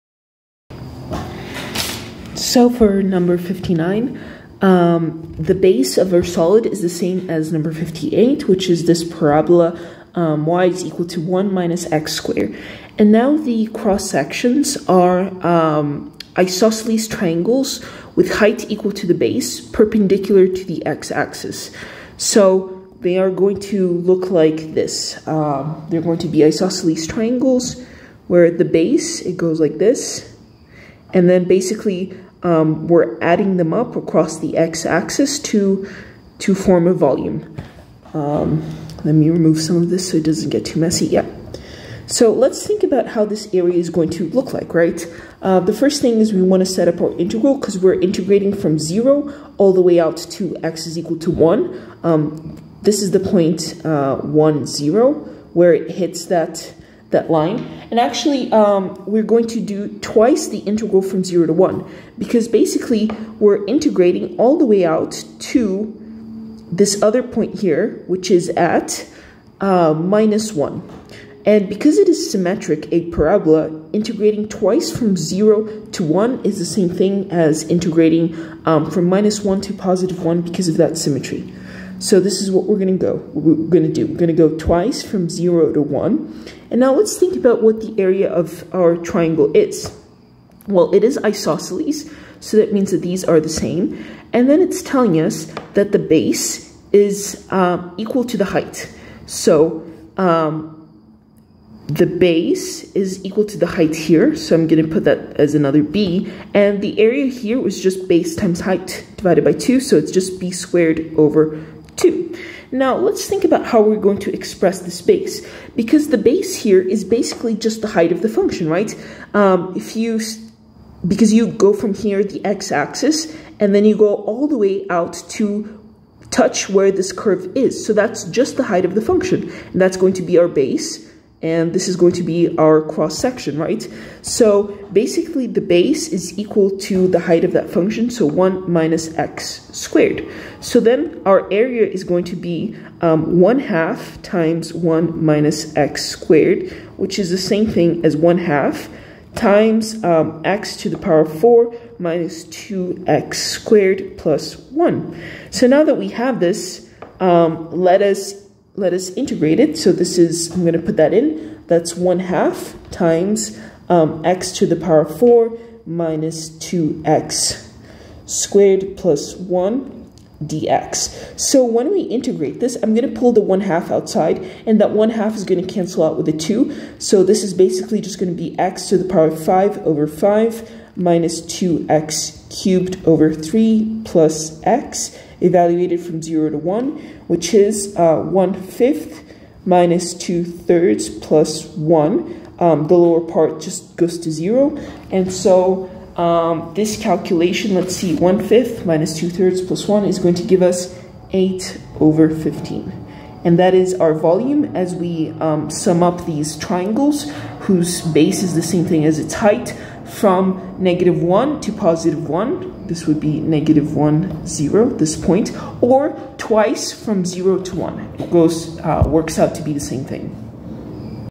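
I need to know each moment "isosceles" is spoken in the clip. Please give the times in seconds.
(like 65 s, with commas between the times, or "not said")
16 s, 26 s, 91 s.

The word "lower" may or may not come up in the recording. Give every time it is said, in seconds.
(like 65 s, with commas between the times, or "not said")
192 s.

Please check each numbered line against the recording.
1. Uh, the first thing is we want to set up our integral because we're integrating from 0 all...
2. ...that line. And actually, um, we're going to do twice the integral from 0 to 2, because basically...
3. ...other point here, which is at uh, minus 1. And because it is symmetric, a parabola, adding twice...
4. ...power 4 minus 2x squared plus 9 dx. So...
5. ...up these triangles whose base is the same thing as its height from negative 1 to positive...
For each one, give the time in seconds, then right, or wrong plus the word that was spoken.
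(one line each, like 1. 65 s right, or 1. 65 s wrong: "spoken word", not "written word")
1. 45 s right
2. 57 s wrong: "1", not "2"
3. 67 s wrong: "integrating", not "adding"
4. 164 s wrong: "1", not "9"
5. 206 s right.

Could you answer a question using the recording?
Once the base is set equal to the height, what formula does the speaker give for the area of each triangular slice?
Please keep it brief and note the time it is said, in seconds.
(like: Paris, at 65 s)
b squared over 2, at 110 s.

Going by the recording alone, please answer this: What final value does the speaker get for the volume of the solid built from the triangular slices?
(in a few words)
8/15.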